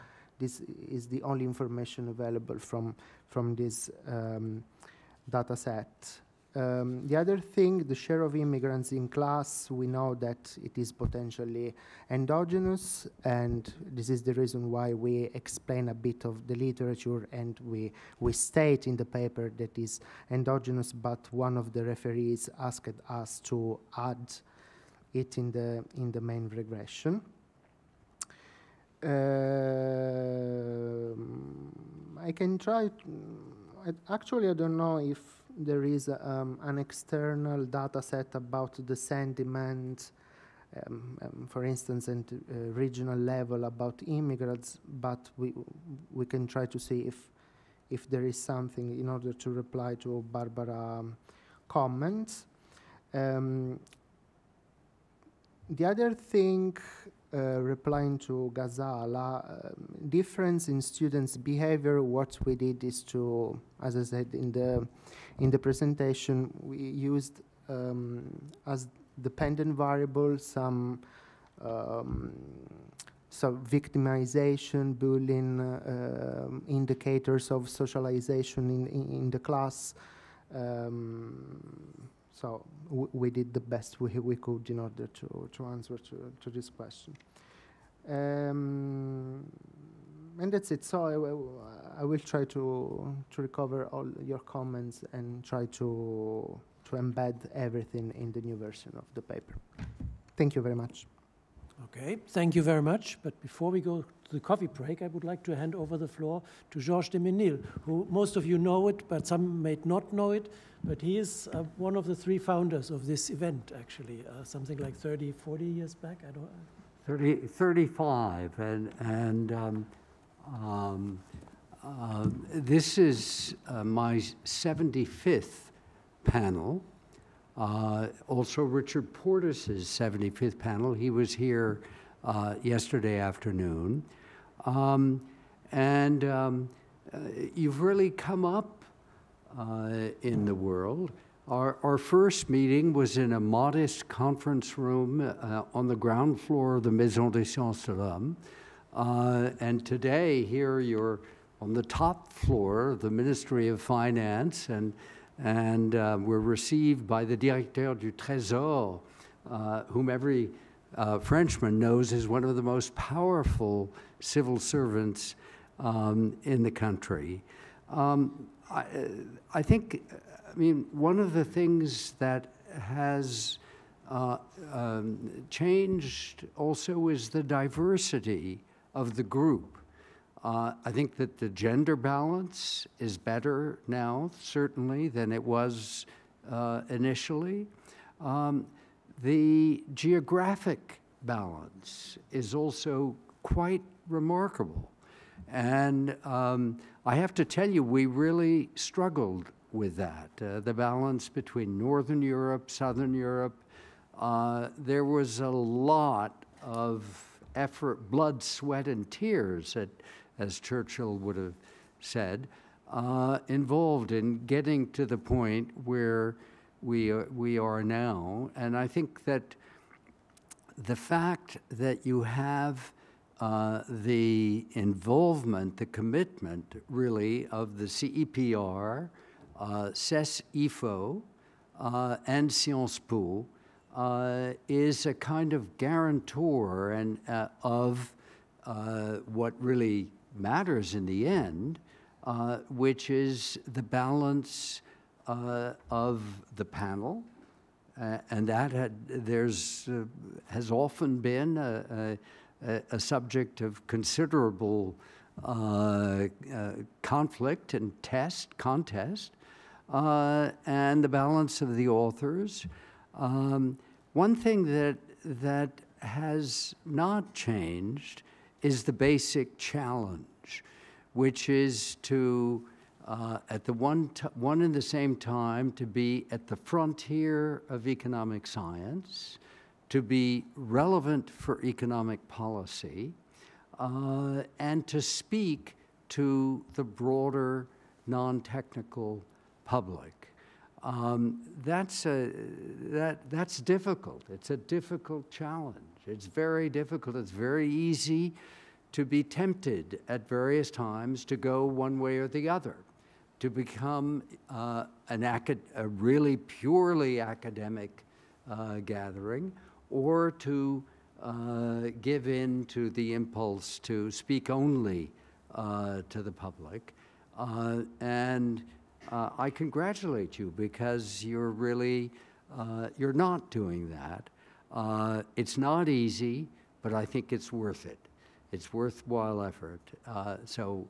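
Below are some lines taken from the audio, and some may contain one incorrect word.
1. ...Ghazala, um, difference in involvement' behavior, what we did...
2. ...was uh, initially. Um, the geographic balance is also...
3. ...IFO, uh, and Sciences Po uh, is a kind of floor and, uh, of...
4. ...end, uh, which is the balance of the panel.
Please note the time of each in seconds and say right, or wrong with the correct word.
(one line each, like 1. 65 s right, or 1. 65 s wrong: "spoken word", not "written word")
1. 58 s wrong: "students", not "involvement"
2. 185 s right
3. 230 s wrong: "guarantor", not "floor"
4. 241 s right.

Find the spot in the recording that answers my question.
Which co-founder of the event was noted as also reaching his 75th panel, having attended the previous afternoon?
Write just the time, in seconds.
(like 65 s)
128 s.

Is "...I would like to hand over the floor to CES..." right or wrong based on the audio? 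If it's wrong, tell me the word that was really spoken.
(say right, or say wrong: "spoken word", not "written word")
wrong: "Georges", not "CES".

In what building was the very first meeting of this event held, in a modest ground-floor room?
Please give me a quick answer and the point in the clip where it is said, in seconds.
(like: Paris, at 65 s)
Maison des Sciences de l'Homme, at 146 s.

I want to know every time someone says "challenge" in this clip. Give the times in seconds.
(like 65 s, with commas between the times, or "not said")
269 s, 295 s.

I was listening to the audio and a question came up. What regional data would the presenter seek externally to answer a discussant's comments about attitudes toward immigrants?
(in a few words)
sentiment.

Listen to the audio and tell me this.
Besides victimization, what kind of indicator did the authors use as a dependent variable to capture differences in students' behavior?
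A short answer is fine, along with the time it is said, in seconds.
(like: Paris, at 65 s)
bullying, at 74 s.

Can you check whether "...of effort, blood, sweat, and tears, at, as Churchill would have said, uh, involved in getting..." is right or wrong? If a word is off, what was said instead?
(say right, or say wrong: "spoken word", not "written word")
right.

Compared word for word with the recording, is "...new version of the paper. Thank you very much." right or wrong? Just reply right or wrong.
right.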